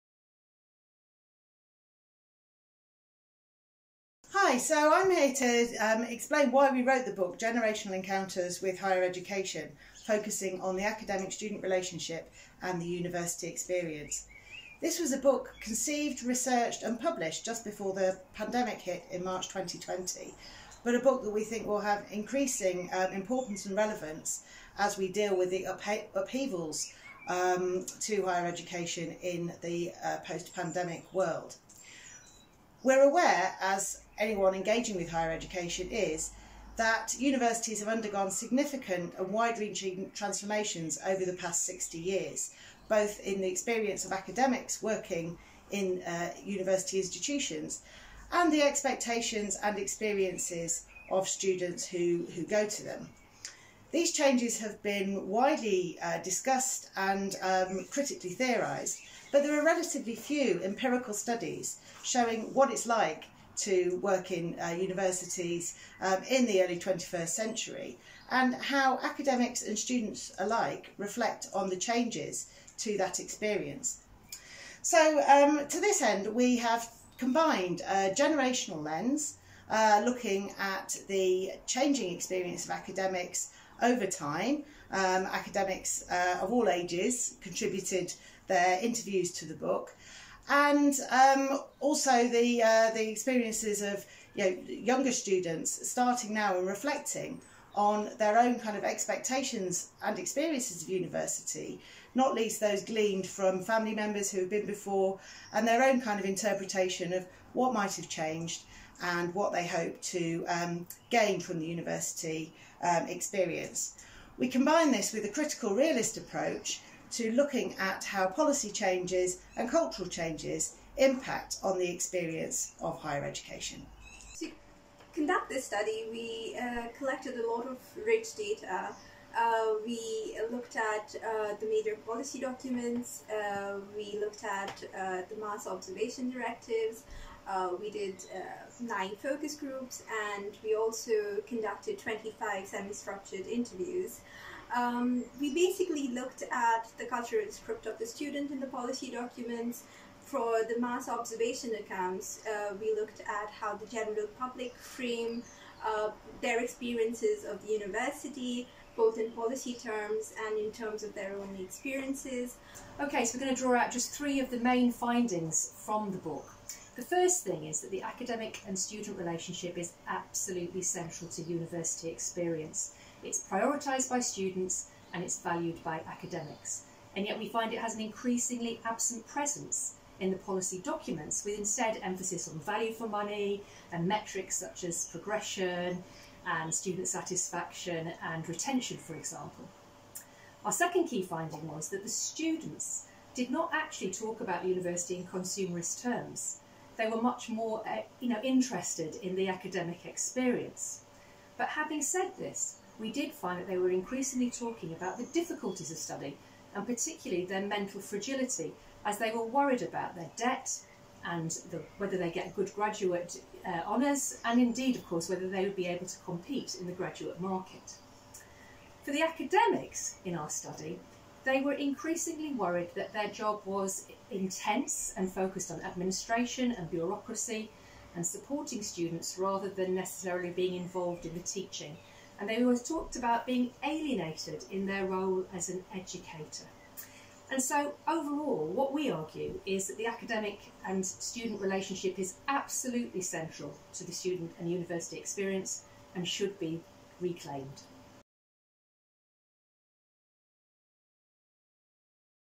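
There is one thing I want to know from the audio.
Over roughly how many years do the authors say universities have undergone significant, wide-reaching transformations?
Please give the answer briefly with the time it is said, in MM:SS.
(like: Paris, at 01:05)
60 years, at 00:41.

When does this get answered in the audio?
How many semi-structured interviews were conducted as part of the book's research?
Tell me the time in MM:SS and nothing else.
02:21.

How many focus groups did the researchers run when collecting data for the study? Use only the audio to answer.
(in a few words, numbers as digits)
9.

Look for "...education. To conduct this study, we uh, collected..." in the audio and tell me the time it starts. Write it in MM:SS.
02:03.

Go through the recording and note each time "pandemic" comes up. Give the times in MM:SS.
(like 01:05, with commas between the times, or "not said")
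00:18, 00:30.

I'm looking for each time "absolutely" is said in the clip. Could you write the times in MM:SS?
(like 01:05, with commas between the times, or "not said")
02:50, 04:02.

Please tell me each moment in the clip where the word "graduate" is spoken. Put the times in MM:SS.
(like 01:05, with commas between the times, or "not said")
03:32, 03:36.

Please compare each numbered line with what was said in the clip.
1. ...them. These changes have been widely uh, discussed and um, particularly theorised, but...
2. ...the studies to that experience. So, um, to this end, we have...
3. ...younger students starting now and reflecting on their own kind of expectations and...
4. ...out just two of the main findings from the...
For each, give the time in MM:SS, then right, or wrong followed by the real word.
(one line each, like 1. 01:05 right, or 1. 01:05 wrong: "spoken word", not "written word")
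1. 00:52 wrong: "critically", not "particularly"
2. 01:11 wrong: "changes", not "studies"
3. 01:34 right
4. 02:43 wrong: "three", not "two".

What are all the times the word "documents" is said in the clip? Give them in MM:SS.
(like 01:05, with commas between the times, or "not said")
02:12, 02:29, 03:00.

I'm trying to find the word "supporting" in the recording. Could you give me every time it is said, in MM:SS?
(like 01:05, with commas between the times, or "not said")
03:48.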